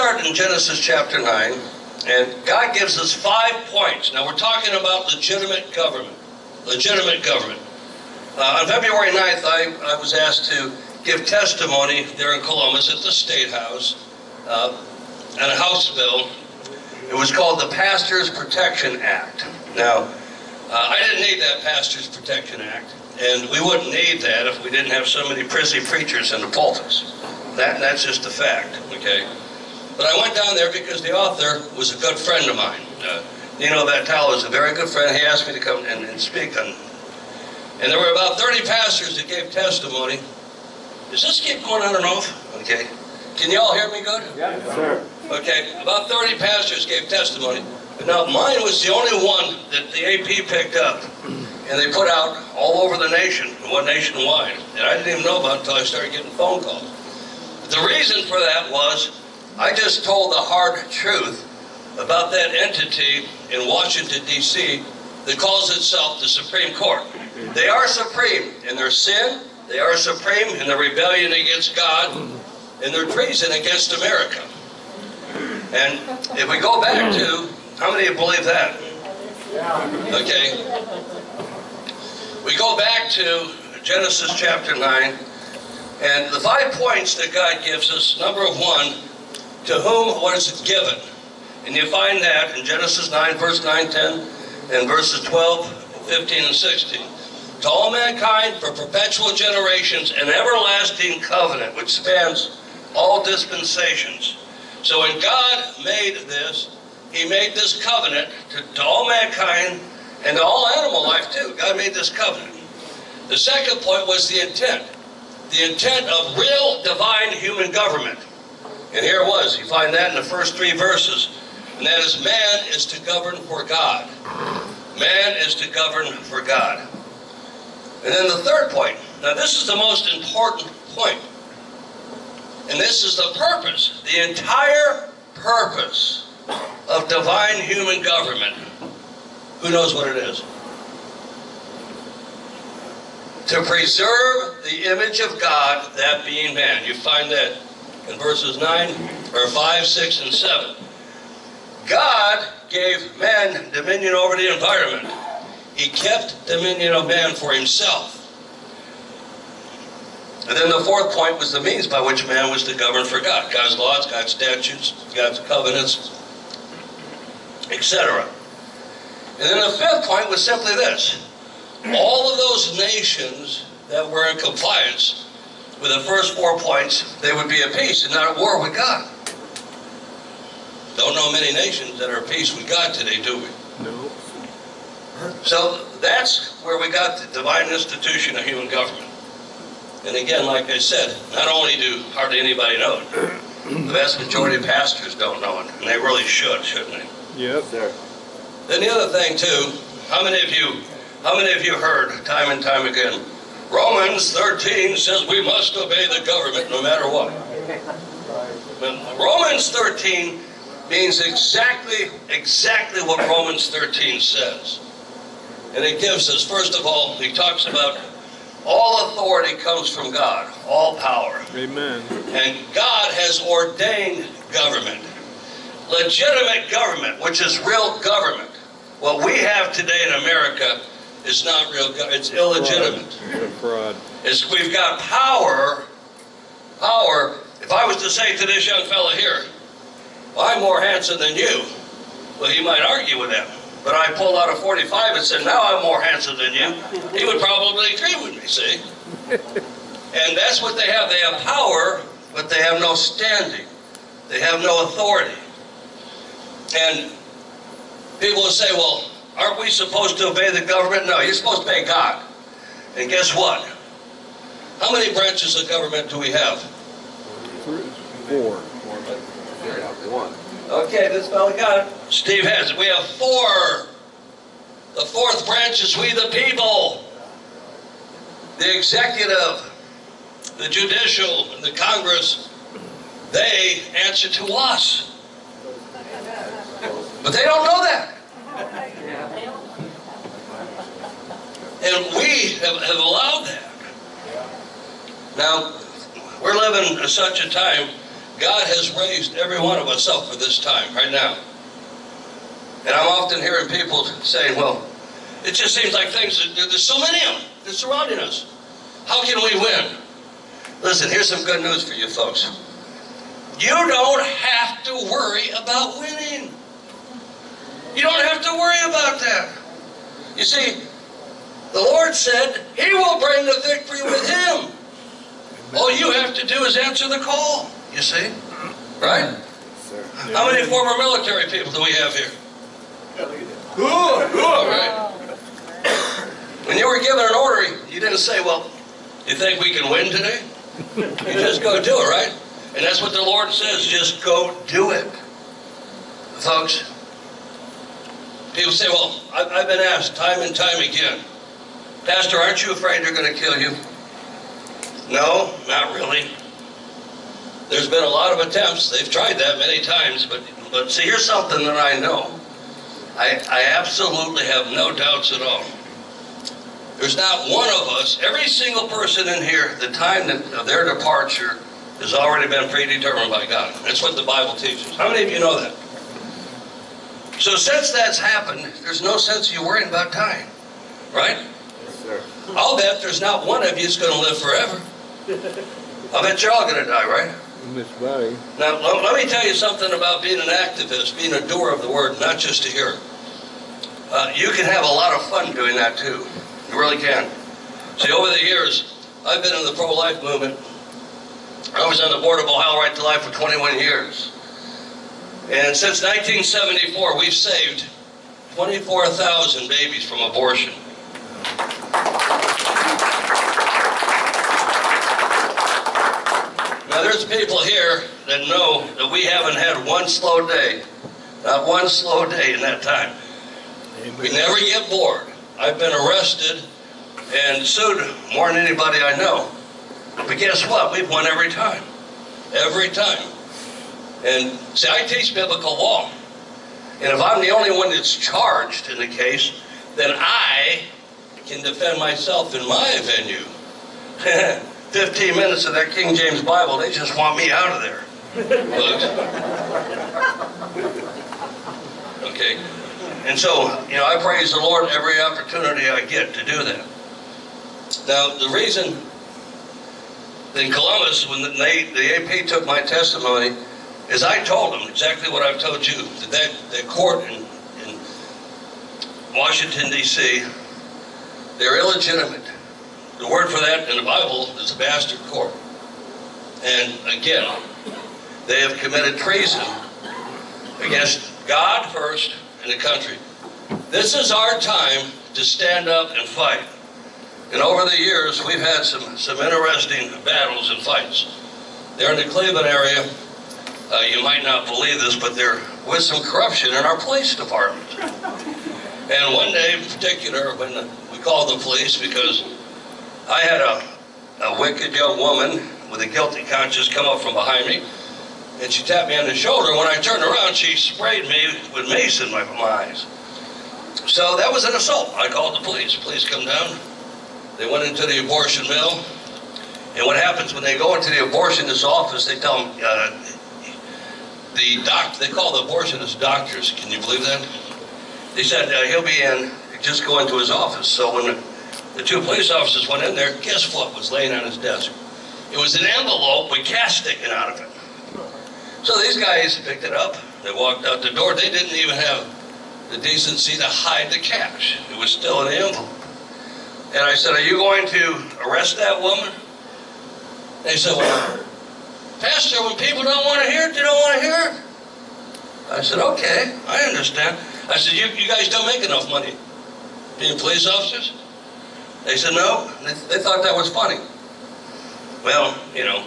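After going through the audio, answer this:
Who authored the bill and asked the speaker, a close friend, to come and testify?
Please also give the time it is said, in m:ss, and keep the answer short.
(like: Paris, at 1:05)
Nino Vitale, at 0:33.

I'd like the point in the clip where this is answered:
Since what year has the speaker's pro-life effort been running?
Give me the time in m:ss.
6:46.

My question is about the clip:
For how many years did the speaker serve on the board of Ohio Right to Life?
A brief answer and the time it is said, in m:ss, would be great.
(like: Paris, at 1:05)
21, at 6:43.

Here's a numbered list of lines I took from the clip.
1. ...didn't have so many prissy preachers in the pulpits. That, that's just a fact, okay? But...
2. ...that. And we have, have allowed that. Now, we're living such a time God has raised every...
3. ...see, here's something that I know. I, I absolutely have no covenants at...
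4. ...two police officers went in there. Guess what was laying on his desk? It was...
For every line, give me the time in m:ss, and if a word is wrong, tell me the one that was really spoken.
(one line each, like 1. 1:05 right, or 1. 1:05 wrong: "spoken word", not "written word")
1. 0:24 right
2. 4:47 right
3. 6:00 wrong: "doubts", not "covenants"
4. 8:52 right.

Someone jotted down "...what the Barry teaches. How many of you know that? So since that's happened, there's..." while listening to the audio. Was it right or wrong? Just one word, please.
wrong.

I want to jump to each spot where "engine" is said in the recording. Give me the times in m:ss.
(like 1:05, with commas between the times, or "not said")
not said.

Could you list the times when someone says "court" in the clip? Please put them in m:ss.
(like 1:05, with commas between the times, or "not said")
1:06, 7:46, 7:55.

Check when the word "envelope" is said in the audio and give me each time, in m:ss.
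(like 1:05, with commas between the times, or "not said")
8:55, 9:05.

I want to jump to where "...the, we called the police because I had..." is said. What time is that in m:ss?
8:20.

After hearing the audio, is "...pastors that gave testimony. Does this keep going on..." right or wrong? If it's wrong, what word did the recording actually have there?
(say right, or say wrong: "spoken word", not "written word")
right.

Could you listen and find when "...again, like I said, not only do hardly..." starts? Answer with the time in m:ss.
3:10.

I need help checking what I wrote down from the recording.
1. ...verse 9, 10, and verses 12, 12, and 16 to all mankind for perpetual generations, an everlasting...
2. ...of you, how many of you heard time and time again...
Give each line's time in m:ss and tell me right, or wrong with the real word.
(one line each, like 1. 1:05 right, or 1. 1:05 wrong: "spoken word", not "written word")
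1. 1:33 wrong: "15", not "12"
2. 3:20 right.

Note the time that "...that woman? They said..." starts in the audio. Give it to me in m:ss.
9:08.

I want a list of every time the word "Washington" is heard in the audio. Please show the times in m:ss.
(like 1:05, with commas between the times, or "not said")
1:03, 7:49.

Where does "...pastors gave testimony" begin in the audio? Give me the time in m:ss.
0:46.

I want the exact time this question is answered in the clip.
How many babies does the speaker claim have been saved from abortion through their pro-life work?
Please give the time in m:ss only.
6:48.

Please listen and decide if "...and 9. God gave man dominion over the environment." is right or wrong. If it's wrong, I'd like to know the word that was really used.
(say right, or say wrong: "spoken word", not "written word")
wrong: "7", not "9".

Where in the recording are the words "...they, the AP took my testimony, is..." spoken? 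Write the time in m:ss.
7:41.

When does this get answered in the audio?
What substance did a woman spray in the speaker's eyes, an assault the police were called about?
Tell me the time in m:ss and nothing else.
8:31.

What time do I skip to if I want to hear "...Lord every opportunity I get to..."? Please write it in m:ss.
7:34.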